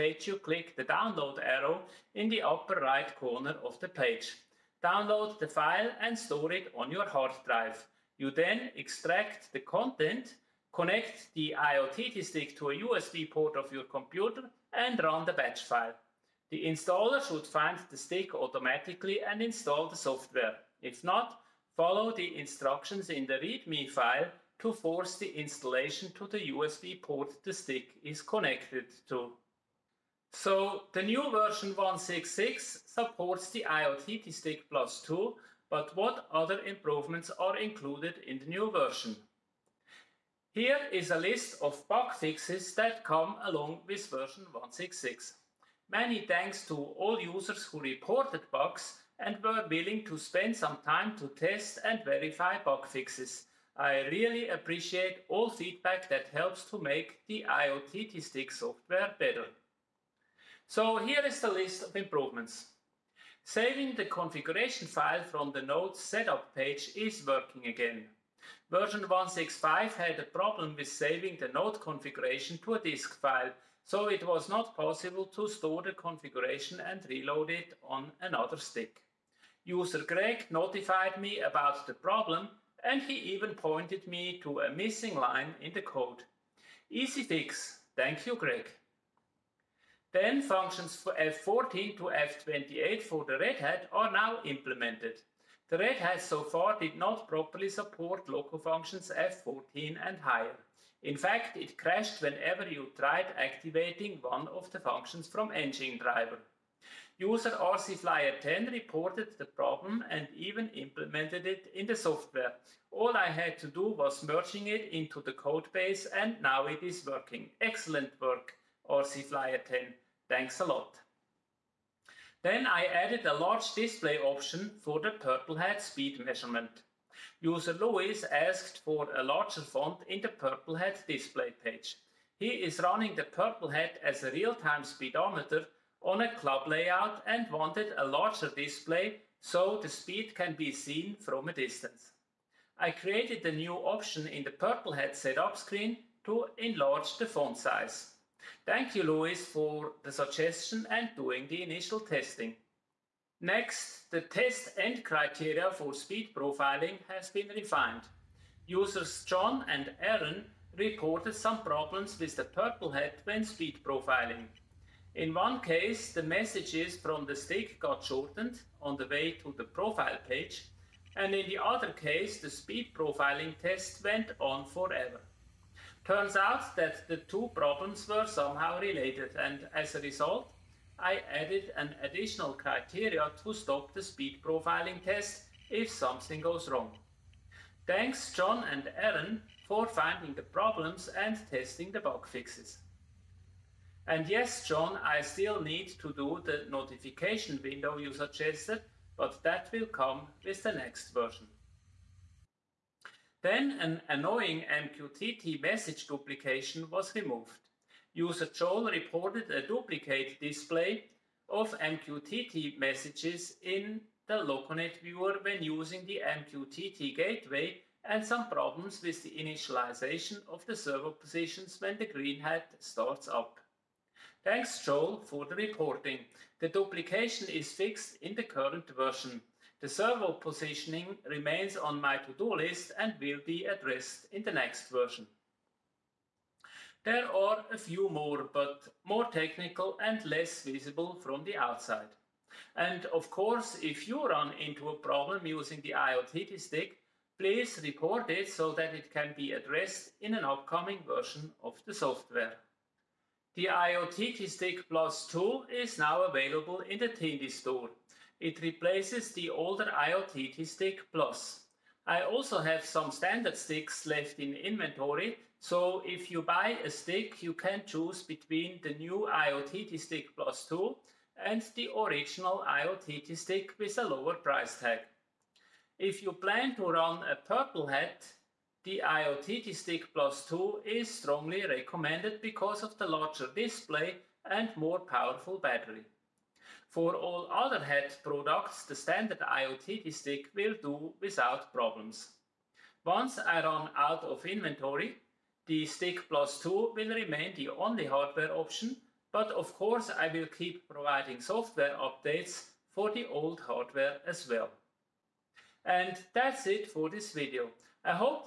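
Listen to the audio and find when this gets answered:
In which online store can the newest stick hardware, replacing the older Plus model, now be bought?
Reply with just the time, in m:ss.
4:17.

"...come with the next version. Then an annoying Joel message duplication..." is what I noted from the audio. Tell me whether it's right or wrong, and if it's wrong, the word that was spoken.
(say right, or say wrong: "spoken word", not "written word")
wrong: "MQTT", not "Joel".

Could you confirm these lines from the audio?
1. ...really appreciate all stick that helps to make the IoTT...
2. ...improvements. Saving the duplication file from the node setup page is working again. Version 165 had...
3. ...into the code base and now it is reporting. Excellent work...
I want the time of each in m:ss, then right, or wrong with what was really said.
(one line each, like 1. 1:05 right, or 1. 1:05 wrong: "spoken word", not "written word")
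1. 0:54 wrong: "feedback", not "stick"
2. 1:01 wrong: "configuration", not "duplication"
3. 1:54 wrong: "working", not "reporting".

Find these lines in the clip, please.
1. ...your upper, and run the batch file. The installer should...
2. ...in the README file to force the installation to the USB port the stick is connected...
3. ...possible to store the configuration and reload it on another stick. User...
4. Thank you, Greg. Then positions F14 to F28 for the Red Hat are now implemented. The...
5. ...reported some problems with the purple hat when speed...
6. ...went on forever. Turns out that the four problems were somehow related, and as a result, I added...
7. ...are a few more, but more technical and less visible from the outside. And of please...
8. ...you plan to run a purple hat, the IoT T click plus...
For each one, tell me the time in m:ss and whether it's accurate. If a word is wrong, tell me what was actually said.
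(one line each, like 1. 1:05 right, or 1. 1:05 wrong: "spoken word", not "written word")
1. 0:13 wrong: "computer", not "upper"
2. 0:23 right
3. 1:14 right
4. 1:27 wrong: "functions", not "positions"
5. 2:40 right
6. 2:54 wrong: "two", not "four"
7. 3:57 wrong: "course", not "please"
8. 4:36 wrong: "stick", not "click".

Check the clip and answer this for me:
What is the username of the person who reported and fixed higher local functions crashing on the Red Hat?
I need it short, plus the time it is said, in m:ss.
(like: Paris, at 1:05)
RcFlyer10, at 1:47.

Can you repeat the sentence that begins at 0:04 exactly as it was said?
Download the file and store it on your hard drive.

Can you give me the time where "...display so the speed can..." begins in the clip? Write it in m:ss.
2:18.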